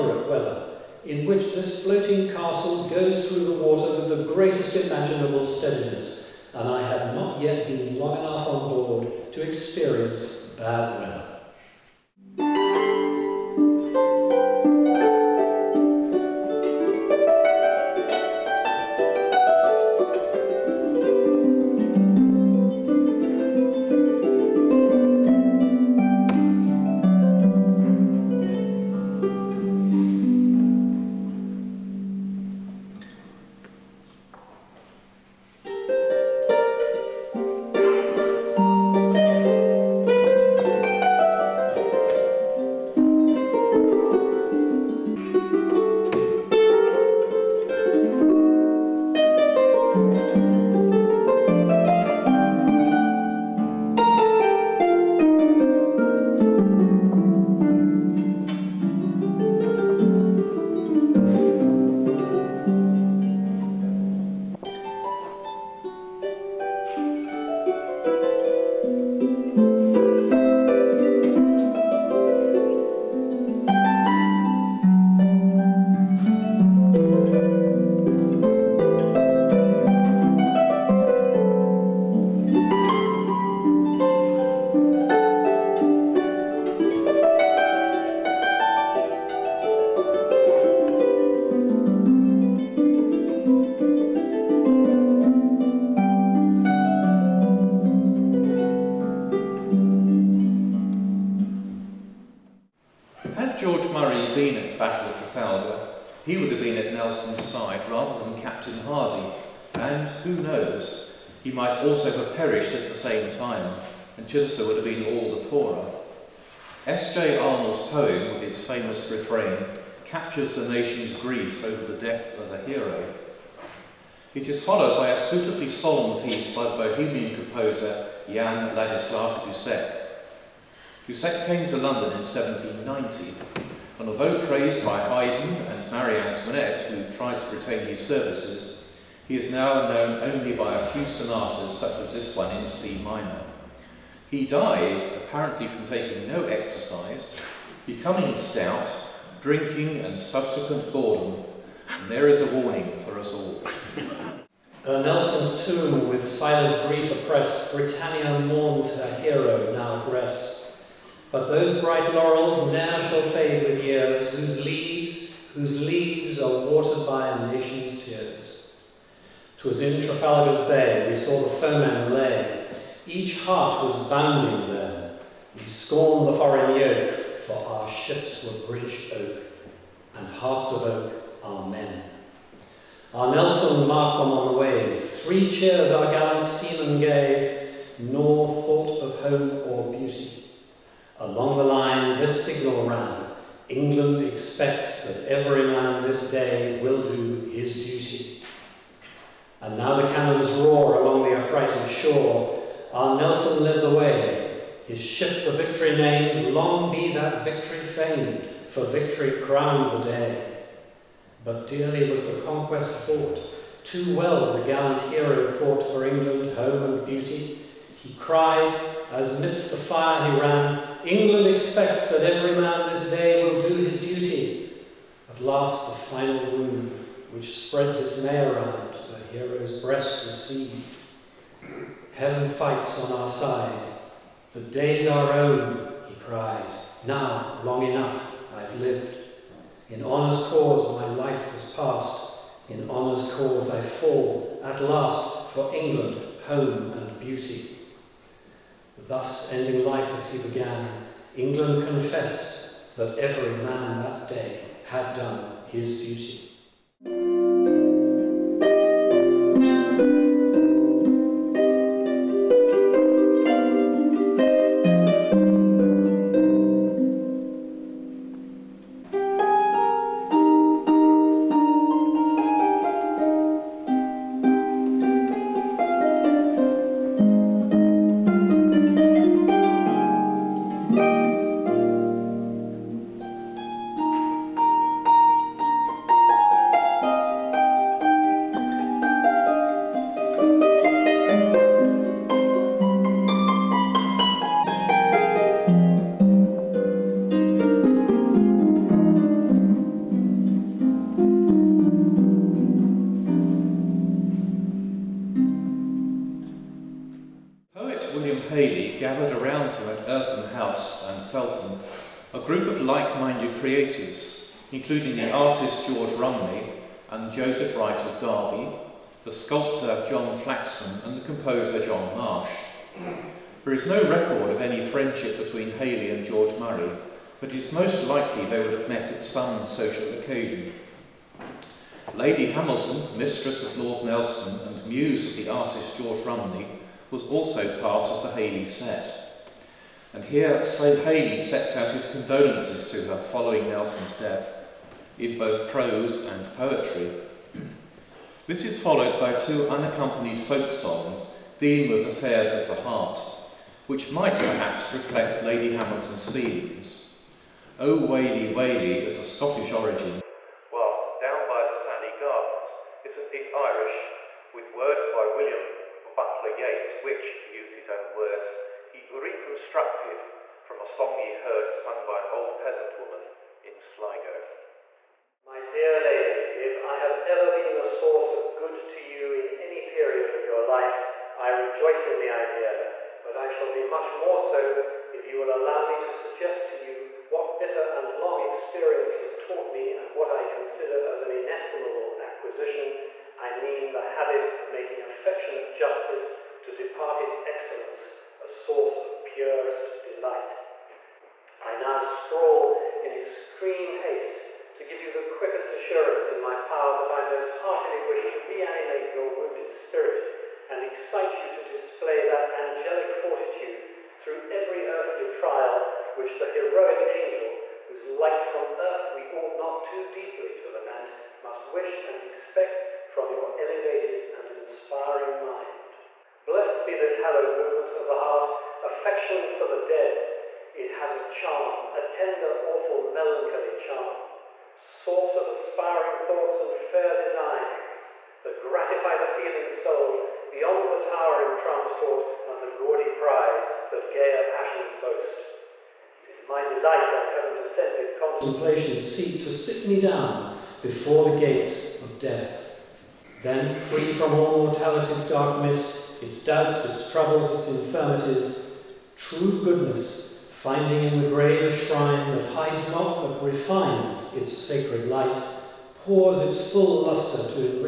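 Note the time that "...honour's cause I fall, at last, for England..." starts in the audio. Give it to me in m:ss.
4:02.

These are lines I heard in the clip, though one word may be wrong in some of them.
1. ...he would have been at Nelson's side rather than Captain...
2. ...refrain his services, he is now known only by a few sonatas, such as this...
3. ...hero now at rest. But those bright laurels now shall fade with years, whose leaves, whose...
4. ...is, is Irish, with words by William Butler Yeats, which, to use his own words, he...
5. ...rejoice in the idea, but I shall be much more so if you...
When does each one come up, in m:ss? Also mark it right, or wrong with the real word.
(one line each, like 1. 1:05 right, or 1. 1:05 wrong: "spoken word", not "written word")
1. 1:46 right
2. 2:17 wrong: "retain", not "refrain"
3. 2:39 right
4. 6:03 right
5. 6:21 right.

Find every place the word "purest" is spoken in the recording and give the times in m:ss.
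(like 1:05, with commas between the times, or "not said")
6:39.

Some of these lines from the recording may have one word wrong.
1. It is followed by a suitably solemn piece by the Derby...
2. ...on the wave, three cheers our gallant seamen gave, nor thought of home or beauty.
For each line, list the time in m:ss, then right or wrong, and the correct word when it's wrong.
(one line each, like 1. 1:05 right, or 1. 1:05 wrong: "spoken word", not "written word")
1. 2:04 wrong: "Bohemian", not "Derby"
2. 3:04 right.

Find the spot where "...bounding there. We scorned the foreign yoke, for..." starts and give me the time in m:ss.
2:54.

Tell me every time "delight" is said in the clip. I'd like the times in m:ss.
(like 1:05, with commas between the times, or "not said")
6:40, 7:26.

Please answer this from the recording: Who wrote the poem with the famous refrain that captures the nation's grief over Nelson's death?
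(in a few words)
S.J. Arnold.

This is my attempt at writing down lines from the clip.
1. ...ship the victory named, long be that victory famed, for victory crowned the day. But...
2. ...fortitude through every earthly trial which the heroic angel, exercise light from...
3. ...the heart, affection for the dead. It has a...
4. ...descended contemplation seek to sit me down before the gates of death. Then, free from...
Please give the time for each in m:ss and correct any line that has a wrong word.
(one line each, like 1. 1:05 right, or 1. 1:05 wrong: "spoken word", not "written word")
1. 3:25 right
2. 6:53 wrong: "whose", not "exercise"
3. 7:08 right
4. 7:27 right.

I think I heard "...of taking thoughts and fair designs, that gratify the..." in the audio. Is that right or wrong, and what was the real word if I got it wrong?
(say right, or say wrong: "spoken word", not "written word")
wrong: "aspiring", not "taking".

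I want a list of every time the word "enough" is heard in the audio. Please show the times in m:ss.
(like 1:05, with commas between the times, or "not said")
0:08, 3:57.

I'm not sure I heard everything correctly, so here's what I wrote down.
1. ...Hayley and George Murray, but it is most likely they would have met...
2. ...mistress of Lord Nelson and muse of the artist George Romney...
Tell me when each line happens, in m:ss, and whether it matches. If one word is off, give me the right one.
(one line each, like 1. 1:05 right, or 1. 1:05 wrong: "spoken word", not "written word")
1. 5:25 right
2. 5:33 right.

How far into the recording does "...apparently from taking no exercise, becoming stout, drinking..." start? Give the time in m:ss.
2:25.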